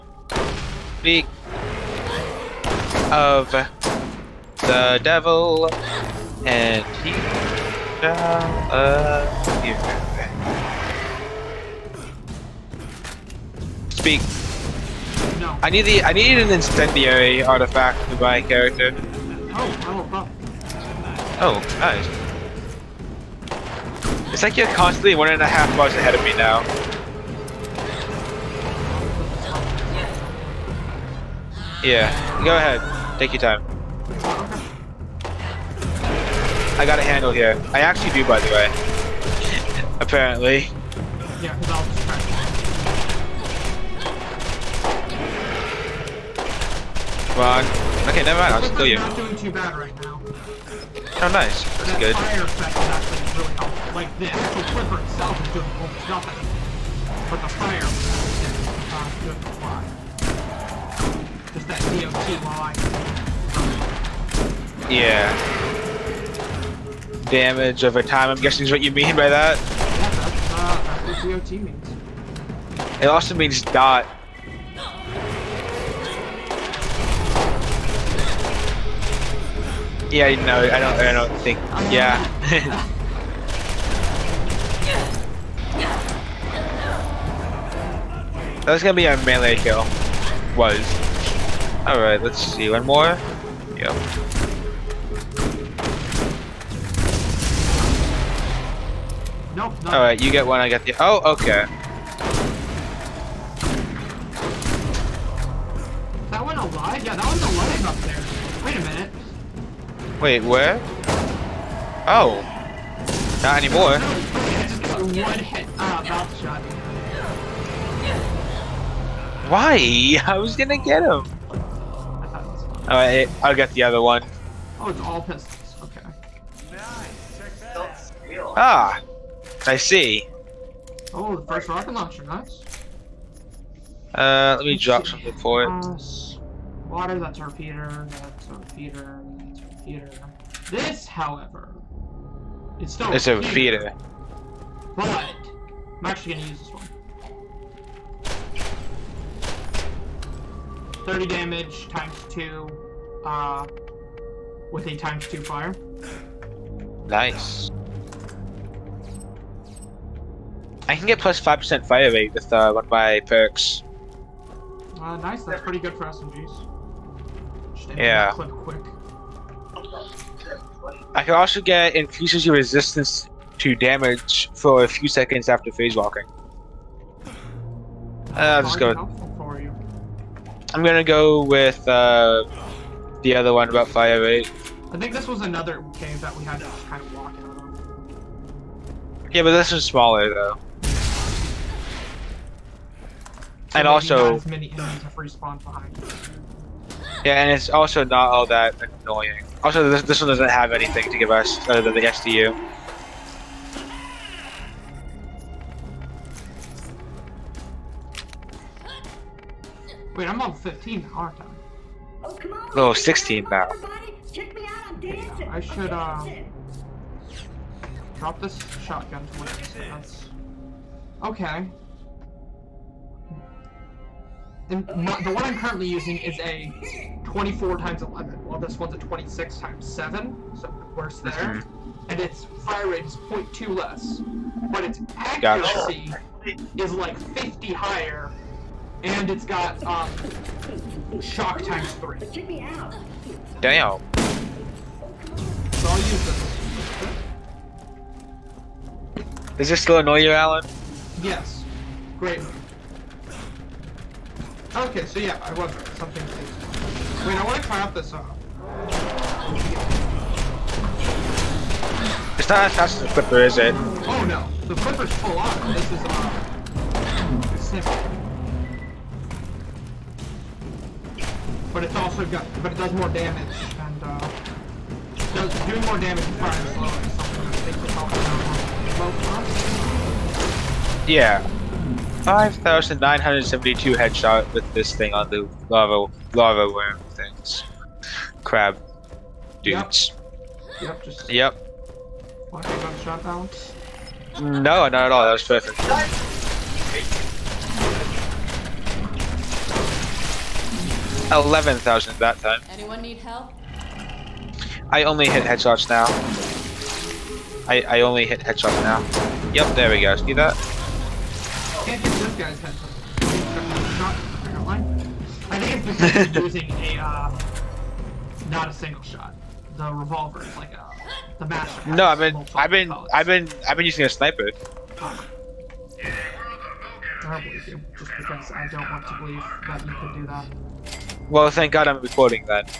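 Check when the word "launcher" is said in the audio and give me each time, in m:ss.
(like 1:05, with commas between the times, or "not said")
2:11.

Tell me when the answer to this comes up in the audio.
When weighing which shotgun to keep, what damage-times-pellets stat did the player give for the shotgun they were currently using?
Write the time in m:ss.
3:47.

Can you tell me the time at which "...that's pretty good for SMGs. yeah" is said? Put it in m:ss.
2:45.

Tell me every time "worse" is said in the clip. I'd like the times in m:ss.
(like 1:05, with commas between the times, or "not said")
3:50.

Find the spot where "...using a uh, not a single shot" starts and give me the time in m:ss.
5:16.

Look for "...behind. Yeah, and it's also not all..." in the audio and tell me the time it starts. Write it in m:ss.
3:15.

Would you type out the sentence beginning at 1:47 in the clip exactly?
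Yeah, that one's alive up there.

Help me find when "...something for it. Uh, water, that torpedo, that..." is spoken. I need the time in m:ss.
2:15.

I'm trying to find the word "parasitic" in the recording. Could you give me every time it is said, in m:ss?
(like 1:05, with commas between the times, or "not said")
not said.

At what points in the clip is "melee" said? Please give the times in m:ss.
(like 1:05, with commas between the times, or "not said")
1:29.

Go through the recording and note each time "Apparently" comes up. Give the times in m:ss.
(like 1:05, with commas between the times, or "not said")
0:40, 5:12.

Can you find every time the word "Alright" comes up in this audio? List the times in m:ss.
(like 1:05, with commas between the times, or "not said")
1:39, 2:02.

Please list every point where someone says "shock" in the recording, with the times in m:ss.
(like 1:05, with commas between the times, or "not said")
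4:01.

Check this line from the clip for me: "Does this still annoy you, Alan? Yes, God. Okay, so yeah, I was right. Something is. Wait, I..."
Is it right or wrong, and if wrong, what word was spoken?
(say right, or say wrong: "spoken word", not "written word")
wrong: "Great", not "God".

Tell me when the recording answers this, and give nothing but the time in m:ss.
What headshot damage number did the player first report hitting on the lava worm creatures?
4:42.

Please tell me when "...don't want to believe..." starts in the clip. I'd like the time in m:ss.
5:28.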